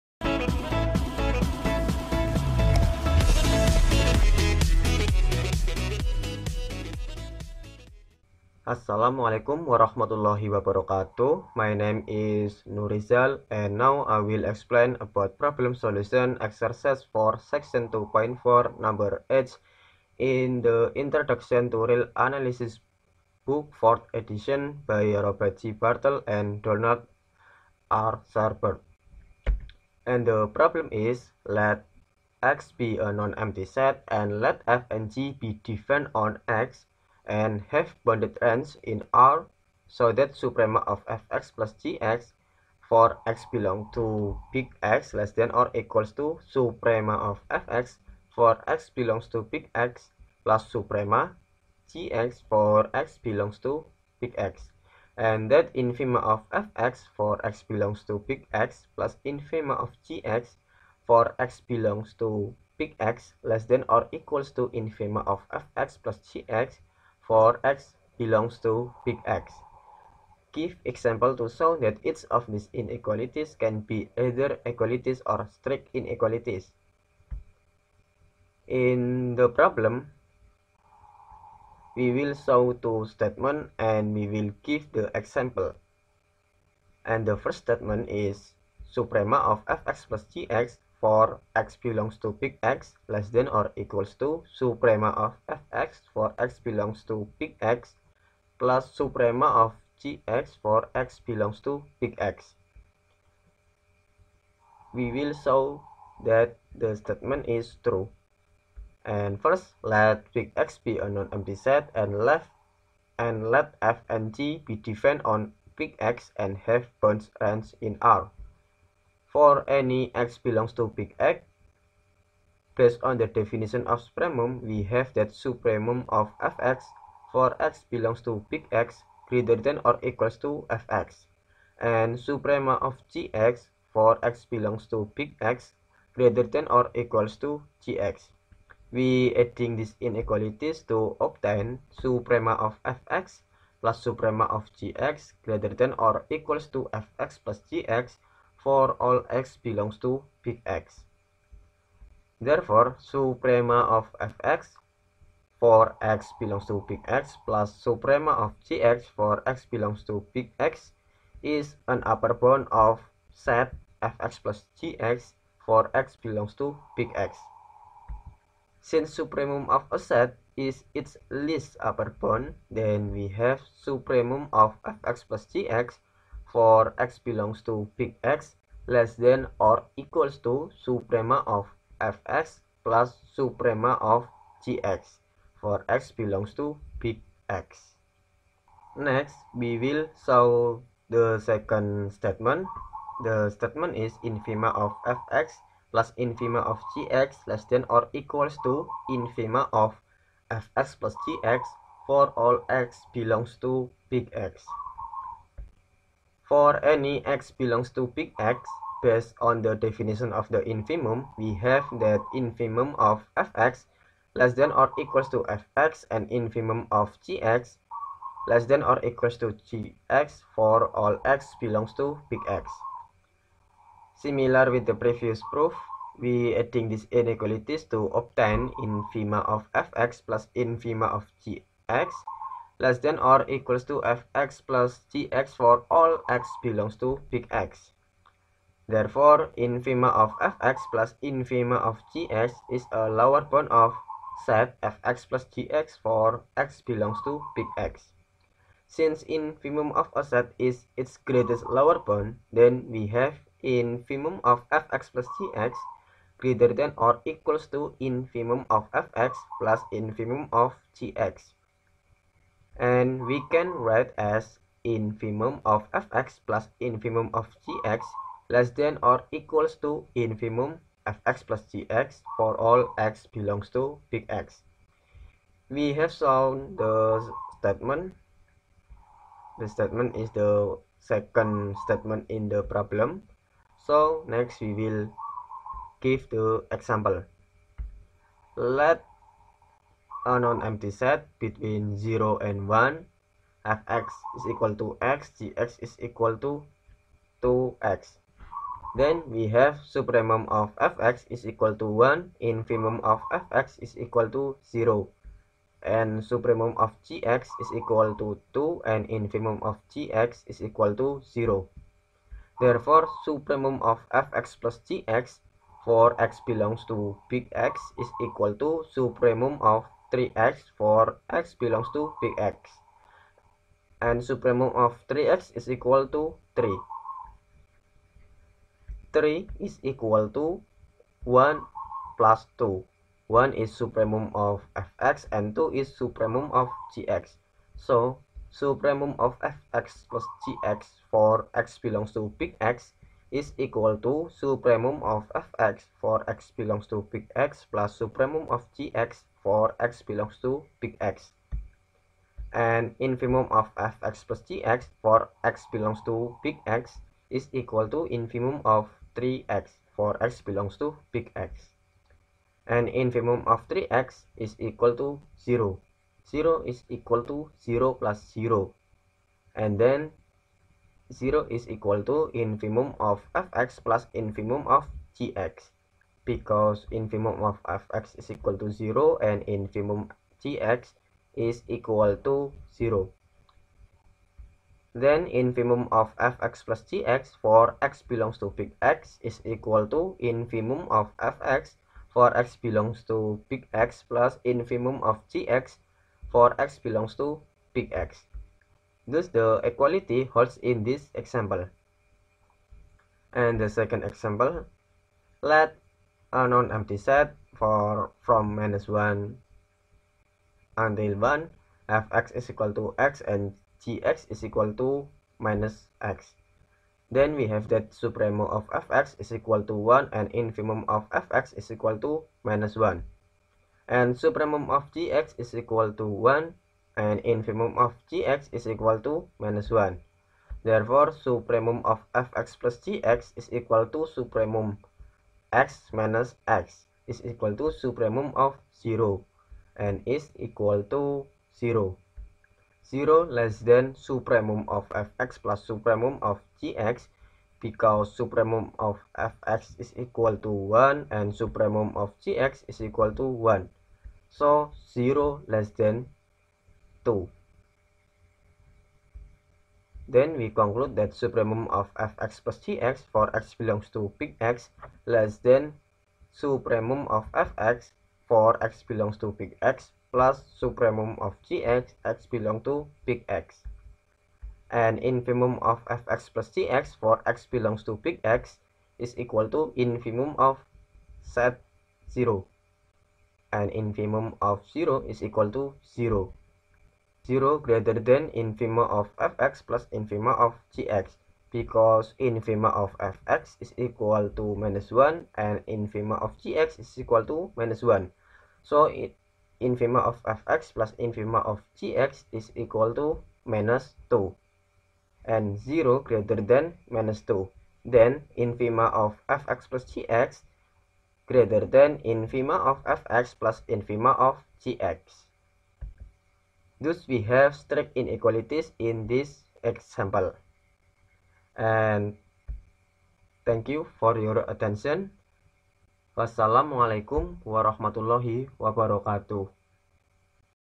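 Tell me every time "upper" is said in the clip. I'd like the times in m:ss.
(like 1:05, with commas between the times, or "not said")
2:42, 2:51.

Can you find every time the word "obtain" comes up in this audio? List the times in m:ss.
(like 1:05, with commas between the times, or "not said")
2:21, 3:48.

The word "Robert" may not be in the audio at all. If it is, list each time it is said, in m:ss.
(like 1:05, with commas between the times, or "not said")
0:25.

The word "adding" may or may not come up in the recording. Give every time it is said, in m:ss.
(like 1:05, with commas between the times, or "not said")
2:19, 3:46.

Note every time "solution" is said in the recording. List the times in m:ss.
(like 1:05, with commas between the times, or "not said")
0:15.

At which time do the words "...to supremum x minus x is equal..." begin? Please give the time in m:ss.
7:13.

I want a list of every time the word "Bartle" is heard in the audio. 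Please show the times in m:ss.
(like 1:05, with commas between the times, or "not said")
0:25.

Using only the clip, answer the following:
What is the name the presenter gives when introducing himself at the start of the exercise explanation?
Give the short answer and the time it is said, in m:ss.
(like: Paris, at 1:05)
Nurizal, at 0:12.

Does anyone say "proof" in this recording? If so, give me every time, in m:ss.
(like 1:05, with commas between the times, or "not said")
3:45.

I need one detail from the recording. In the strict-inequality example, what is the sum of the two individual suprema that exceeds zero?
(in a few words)
2.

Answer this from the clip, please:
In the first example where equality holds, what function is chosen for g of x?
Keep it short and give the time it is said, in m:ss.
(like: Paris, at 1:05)
2x, at 4:55.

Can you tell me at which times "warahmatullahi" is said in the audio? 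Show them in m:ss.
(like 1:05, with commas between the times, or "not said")
0:09, 8:47.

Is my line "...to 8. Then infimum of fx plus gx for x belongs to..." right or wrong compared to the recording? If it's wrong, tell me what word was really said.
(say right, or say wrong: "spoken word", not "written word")
wrong: "0", not "8".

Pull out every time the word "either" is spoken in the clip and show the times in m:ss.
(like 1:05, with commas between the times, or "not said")
1:14.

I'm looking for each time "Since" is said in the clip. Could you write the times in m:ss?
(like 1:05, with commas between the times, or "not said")
2:48, 4:08.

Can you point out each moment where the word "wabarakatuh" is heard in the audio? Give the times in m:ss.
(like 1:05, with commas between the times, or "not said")
0:10, 8:48.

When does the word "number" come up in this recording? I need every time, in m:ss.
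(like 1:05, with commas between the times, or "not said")
0:18.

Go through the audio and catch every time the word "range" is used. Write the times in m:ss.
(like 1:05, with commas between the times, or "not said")
0:38, 1:57.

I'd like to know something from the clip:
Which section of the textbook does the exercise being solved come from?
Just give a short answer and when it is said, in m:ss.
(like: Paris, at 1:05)
2.4, at 0:17.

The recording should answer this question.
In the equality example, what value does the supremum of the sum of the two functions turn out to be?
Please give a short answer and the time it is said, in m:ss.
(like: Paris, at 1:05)
3, at 5:24.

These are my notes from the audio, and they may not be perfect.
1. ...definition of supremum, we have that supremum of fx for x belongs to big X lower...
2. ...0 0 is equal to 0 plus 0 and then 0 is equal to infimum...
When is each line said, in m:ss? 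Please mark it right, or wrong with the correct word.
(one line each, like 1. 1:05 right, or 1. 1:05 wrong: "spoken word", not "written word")
1. 2:03 wrong: "greater", not "lower"
2. 6:05 right.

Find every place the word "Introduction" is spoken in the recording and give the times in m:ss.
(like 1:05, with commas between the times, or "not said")
0:20.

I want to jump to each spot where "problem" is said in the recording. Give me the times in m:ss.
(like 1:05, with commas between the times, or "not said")
0:15, 0:30, 1:19, 4:42.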